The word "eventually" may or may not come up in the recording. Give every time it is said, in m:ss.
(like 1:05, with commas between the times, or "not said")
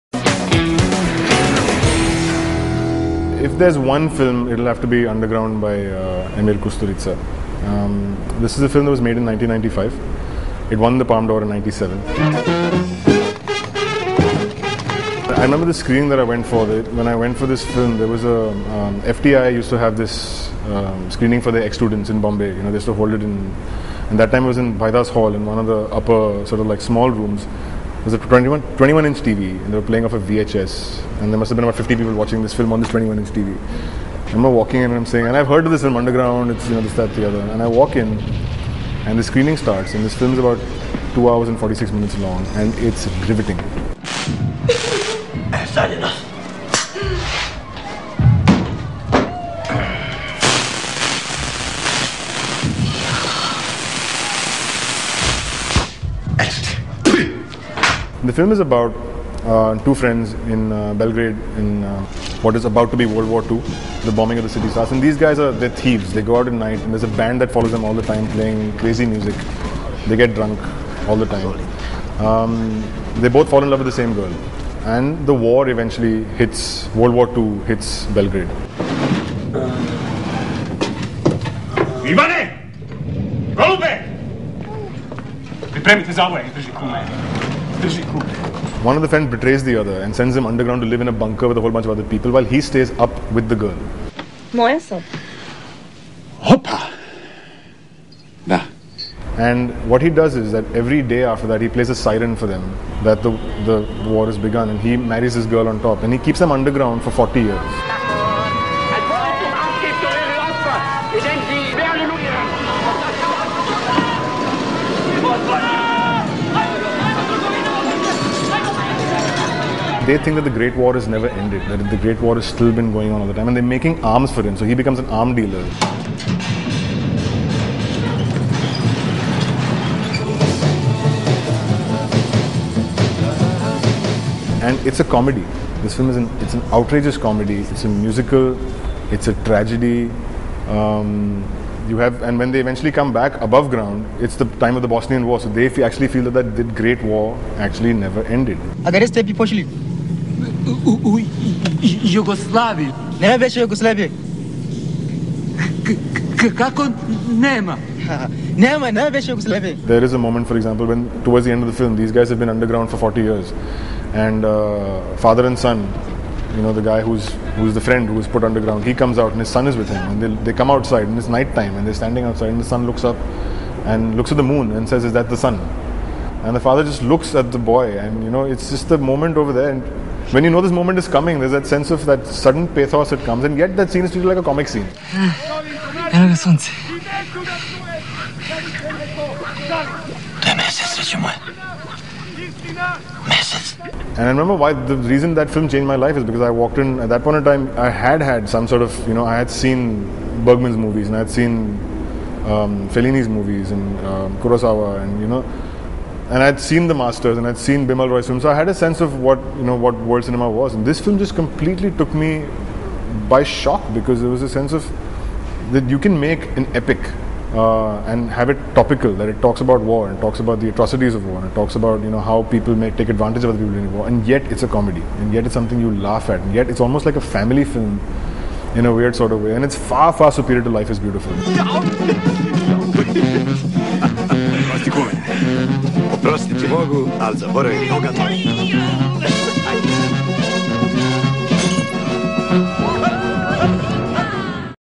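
1:15, 2:22.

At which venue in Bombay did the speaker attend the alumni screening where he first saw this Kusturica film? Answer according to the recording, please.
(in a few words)
Bhaidas Hall.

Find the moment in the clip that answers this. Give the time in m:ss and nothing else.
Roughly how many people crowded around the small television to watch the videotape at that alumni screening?
0:31.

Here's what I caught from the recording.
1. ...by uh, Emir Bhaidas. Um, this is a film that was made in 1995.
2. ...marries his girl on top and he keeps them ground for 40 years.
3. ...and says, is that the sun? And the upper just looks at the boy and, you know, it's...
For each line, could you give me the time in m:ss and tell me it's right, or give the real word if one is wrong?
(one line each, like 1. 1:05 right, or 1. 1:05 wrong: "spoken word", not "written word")
1. 0:05 wrong: "Kusturica", not "Bhaidas"
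2. 1:44 wrong: "underground", not "ground"
3. 2:54 wrong: "father", not "upper".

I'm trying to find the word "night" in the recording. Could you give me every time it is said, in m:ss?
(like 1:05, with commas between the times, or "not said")
1:06, 2:51.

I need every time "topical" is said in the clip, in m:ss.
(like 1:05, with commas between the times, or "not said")
3:38.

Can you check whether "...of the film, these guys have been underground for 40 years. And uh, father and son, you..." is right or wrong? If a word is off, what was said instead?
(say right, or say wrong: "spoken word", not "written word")
right.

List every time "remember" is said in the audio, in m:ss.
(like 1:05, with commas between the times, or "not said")
0:15, 0:34, 3:14.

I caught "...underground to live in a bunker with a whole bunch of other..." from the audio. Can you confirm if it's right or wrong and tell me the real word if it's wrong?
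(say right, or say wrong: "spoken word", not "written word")
right.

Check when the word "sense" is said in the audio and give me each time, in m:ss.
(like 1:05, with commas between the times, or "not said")
3:01, 3:28, 3:34.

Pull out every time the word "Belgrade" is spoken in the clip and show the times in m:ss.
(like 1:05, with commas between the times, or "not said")
1:00, 1:18.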